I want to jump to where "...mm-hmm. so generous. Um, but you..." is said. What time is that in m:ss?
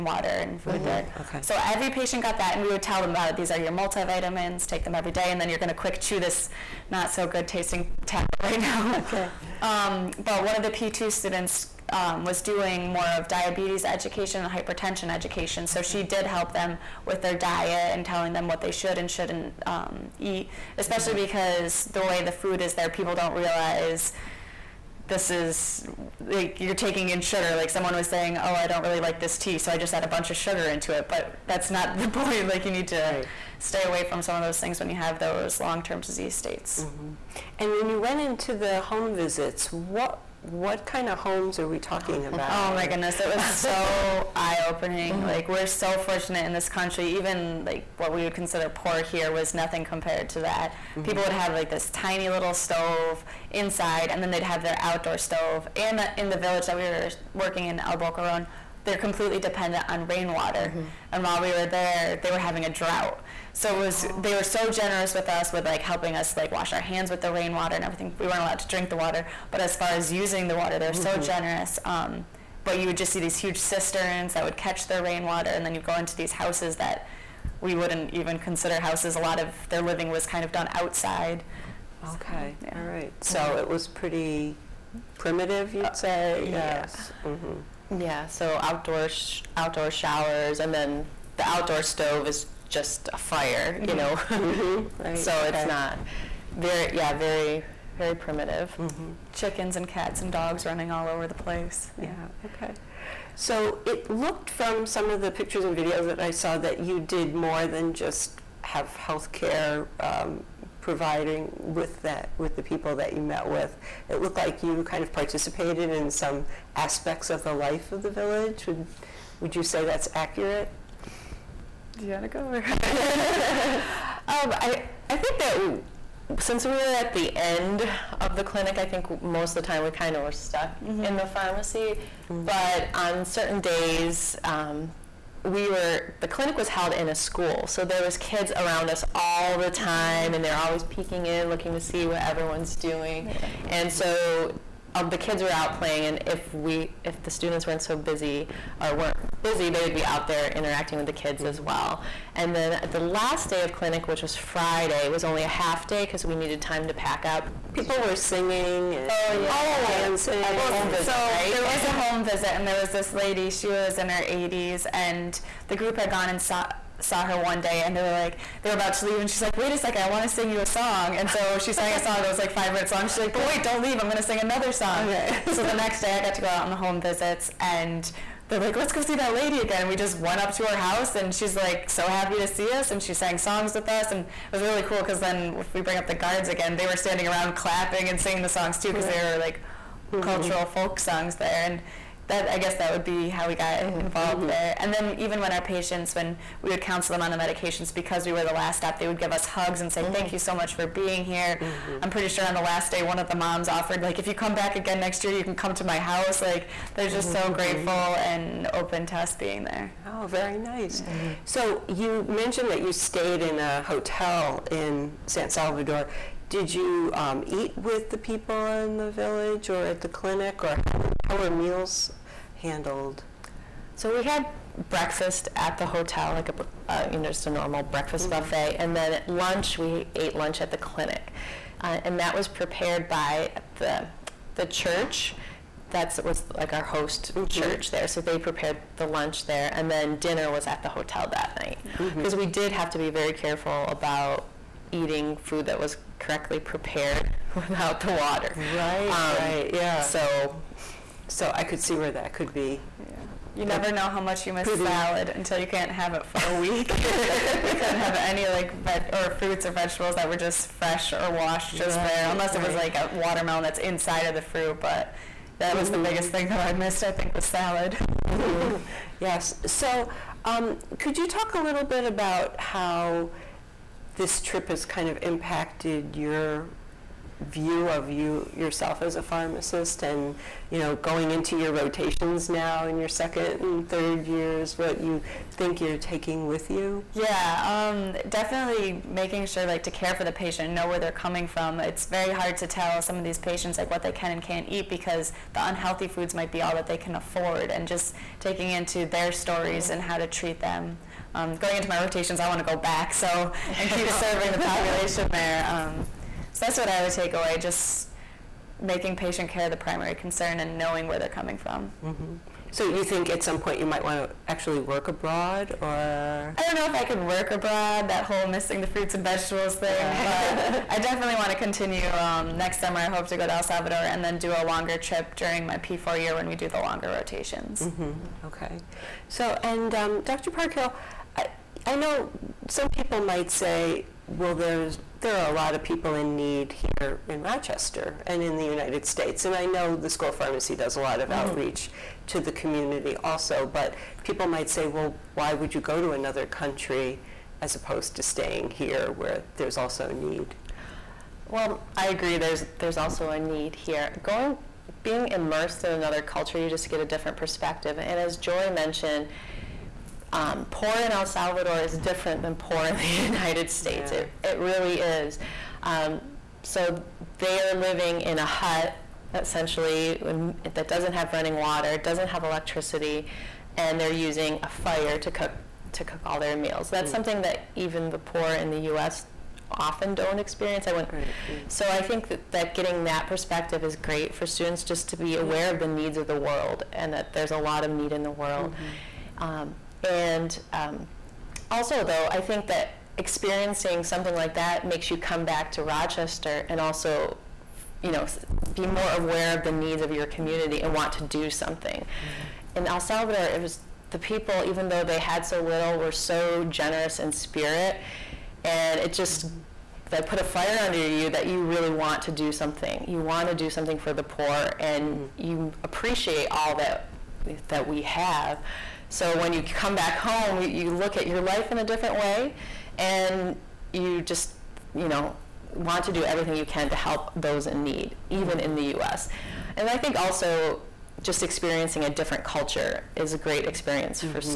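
1:10.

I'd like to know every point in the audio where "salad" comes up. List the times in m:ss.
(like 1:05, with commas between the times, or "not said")
4:14, 4:27.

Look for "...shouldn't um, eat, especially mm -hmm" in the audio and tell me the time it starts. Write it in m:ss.
0:19.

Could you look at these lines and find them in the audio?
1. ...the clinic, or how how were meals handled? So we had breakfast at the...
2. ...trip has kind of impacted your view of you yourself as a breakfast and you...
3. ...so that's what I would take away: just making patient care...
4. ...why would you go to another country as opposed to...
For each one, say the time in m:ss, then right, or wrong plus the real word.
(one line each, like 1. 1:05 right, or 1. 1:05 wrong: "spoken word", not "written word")
1. 3:40 right
2. 4:34 wrong: "pharmacist", not "breakfast"
3. 5:06 right
4. 5:45 right.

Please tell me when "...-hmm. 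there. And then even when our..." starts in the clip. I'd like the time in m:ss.
3:14.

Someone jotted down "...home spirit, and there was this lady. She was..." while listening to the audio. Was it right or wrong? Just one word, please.
wrong.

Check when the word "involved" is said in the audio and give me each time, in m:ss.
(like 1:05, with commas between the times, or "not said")
3:14.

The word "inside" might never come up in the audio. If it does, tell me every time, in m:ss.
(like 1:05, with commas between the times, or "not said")
0:53, 4:23.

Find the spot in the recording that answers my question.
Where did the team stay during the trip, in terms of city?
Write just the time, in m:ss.
3:35.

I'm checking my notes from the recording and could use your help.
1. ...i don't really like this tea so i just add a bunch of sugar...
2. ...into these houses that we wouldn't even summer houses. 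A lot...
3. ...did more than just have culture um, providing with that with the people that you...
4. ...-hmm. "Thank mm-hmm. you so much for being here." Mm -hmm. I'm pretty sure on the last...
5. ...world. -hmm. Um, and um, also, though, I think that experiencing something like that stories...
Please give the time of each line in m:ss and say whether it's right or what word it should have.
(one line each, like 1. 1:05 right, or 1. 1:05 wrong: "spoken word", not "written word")
1. 0:28 right
2. 1:15 wrong: "consider", not "summer"
3. 1:47 wrong: "healthcare", not "culture"
4. 3:20 right
5. 6:28 wrong: "makes", not "stories".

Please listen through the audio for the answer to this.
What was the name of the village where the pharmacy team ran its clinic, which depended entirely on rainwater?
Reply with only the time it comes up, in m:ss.
0:57.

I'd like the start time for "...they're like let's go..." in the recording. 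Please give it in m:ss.
2:58.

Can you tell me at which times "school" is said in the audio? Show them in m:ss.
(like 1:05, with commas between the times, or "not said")
2:17, 5:40.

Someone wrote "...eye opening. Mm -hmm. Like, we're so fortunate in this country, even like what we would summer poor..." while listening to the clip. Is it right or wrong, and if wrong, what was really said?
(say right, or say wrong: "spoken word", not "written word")
wrong: "consider", not "summer".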